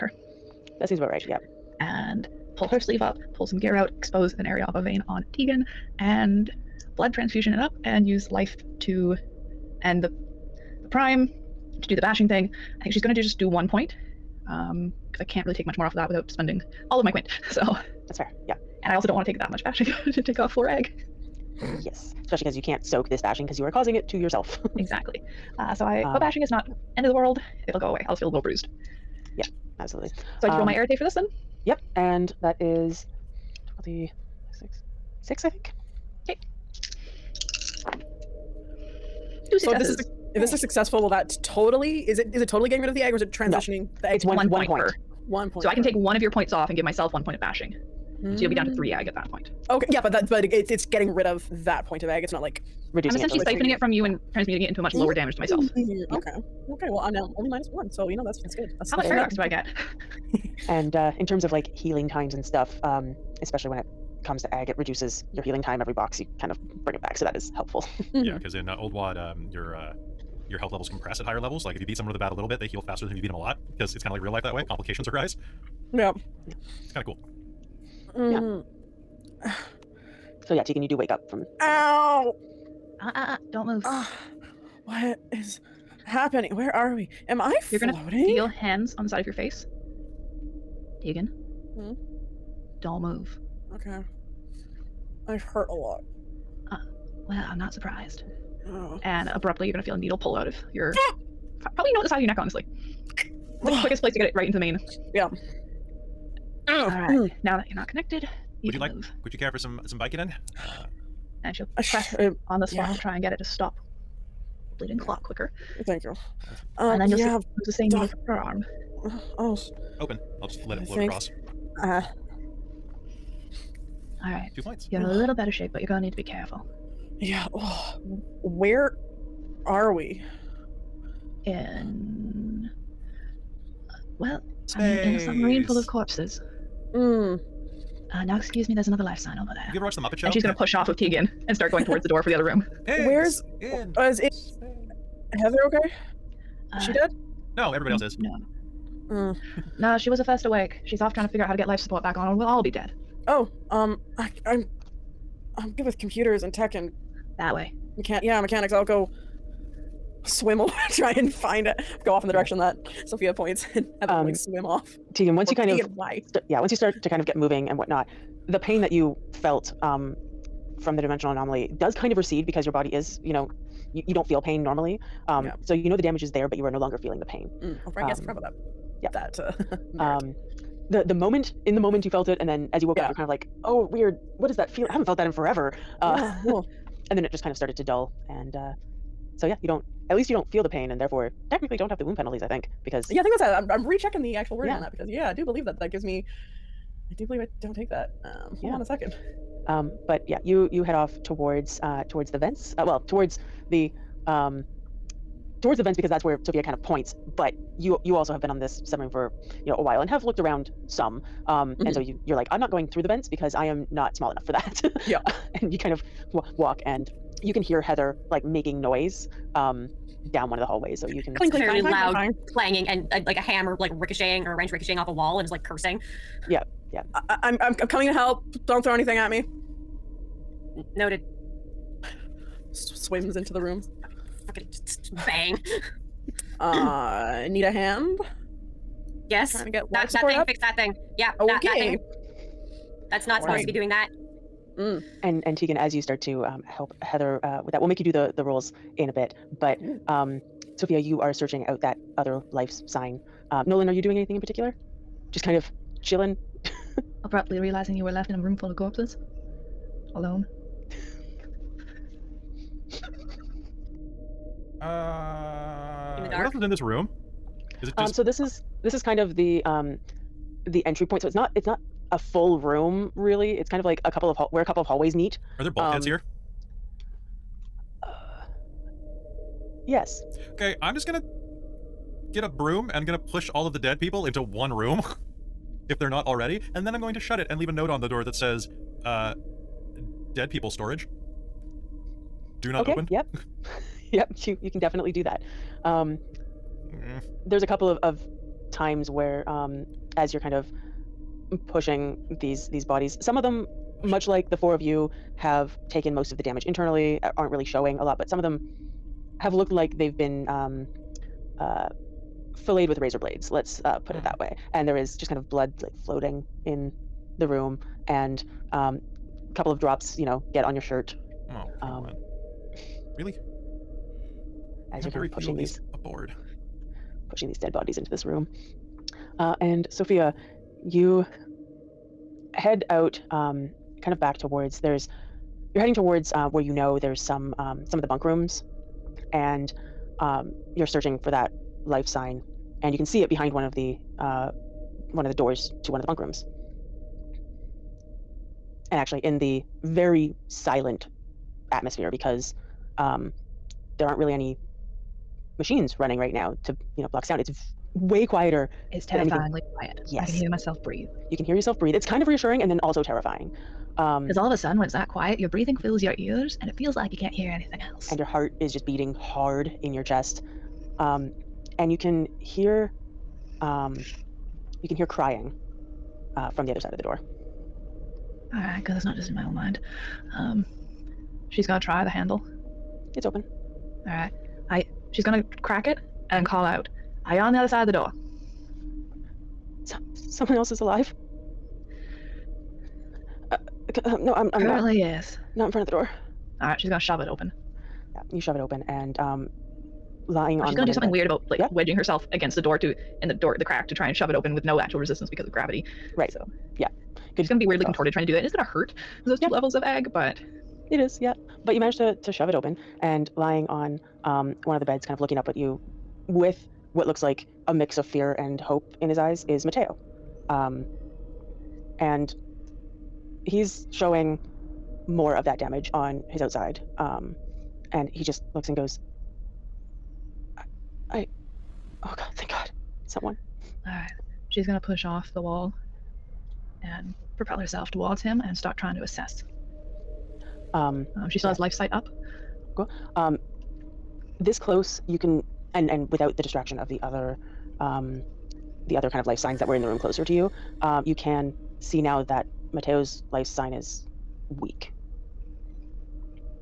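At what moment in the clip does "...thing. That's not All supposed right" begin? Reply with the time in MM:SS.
04:01.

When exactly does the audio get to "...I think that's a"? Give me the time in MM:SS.
03:13.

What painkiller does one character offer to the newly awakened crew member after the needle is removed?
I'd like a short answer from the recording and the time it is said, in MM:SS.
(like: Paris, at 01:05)
Vicodin, at 01:49.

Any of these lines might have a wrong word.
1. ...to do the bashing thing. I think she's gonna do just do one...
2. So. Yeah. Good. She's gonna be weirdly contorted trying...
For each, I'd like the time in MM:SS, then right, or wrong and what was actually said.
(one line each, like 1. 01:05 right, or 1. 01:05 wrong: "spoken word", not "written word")
1. 00:11 right
2. 06:46 right.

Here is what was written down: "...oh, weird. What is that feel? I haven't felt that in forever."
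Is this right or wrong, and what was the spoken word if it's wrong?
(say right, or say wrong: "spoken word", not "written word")
right.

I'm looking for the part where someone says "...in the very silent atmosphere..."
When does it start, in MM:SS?
05:49.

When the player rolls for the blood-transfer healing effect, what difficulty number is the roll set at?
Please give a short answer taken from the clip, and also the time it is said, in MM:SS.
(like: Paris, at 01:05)
6, at 00:33.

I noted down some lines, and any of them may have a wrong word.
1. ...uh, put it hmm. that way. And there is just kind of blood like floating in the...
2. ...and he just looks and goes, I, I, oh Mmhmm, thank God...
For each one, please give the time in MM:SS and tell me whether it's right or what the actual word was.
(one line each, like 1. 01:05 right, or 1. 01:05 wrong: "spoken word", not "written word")
1. 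05:13 right
2. 07:07 wrong: "God", not "Mmhmm".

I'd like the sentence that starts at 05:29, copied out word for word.
Uh, and Sophia, you head out, um, kind of back towards.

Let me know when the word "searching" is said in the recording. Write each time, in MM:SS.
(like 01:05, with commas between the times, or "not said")
04:11, 05:40.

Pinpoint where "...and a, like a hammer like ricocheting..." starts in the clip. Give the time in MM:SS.
03:42.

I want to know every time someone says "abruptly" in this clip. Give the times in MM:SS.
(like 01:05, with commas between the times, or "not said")
01:39, 04:17.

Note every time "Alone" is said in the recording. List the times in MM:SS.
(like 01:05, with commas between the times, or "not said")
04:20.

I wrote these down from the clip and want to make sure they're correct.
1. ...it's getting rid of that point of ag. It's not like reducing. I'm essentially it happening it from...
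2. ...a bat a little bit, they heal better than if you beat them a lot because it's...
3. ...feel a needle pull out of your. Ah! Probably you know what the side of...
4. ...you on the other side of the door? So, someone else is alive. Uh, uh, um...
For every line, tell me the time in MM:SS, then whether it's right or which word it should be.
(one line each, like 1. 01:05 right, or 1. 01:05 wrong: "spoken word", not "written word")
1. 00:50 wrong: "siphoning", not "happening"
2. 01:12 wrong: "faster", not "better"
3. 01:39 right
4. 06:27 right.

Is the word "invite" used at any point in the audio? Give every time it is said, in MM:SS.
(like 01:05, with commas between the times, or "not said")
not said.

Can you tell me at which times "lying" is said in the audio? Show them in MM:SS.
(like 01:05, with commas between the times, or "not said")
06:40, 06:53.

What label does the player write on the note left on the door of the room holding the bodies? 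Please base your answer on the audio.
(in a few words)
Dead people storage.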